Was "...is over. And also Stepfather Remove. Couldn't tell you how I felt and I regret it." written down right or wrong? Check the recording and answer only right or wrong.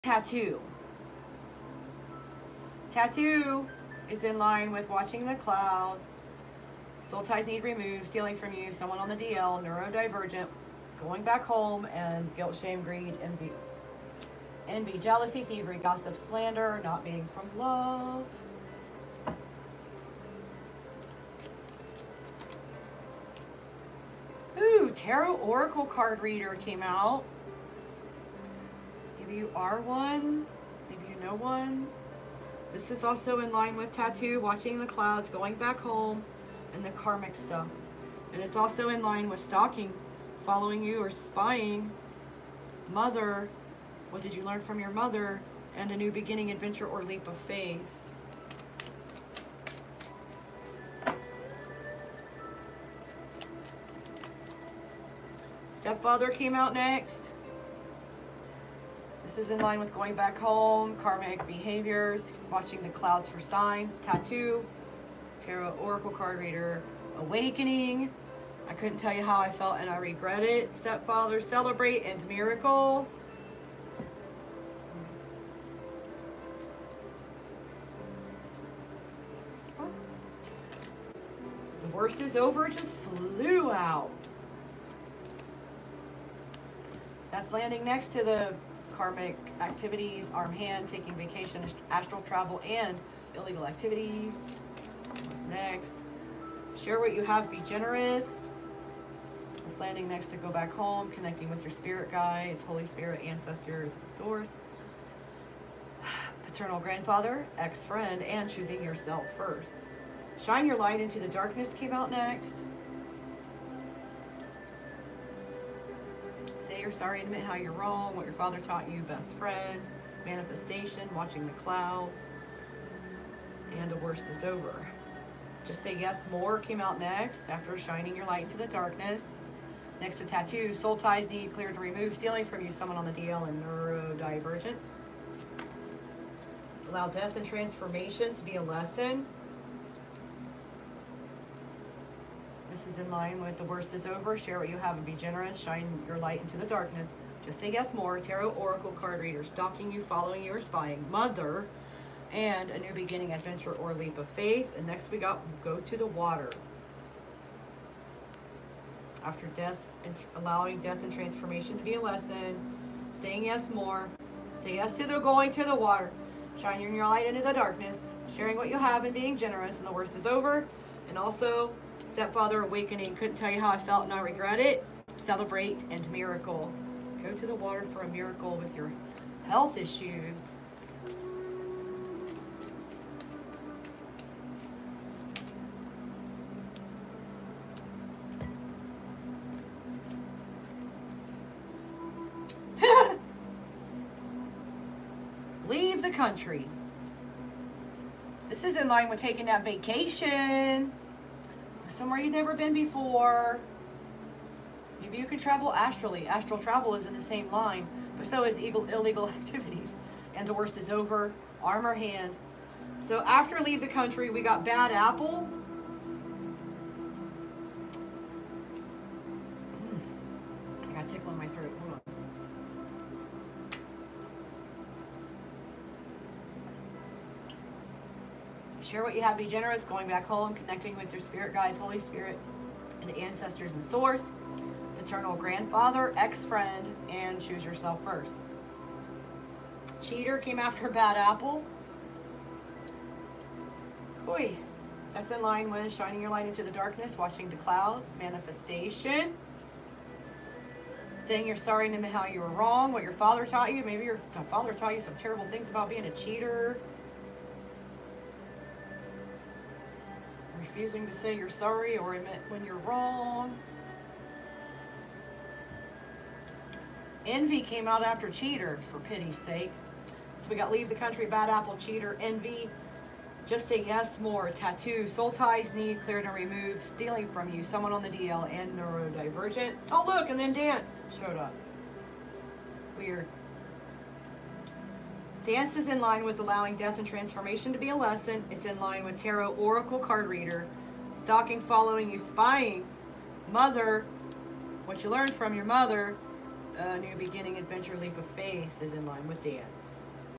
wrong.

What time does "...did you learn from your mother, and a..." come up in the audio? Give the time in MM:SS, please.
00:44.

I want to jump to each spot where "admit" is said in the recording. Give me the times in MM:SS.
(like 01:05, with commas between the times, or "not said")
01:57, 04:22.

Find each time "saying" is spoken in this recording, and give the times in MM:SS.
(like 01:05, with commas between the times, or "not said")
02:43, 04:11.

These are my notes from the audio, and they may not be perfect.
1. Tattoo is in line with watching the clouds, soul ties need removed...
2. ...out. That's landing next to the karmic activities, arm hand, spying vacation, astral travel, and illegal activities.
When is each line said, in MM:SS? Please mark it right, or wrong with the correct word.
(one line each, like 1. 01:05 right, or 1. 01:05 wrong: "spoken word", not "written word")
1. 00:02 right
2. 01:23 wrong: "taking", not "spying".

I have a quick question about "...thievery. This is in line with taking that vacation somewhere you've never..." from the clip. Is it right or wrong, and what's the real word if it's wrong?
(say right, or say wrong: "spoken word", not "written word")
wrong: "country", not "thievery".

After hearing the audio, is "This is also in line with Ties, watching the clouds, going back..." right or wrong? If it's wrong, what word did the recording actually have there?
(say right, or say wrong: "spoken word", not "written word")
wrong: "Tattoo", not "Ties".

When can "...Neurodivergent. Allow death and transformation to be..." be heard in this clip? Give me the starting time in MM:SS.
02:13.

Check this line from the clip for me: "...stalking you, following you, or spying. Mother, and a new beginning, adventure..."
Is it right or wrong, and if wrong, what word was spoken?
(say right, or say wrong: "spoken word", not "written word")
right.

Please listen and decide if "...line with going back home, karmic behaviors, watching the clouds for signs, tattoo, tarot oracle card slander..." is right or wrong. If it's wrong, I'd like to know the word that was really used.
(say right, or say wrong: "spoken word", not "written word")
wrong: "reader", not "slander".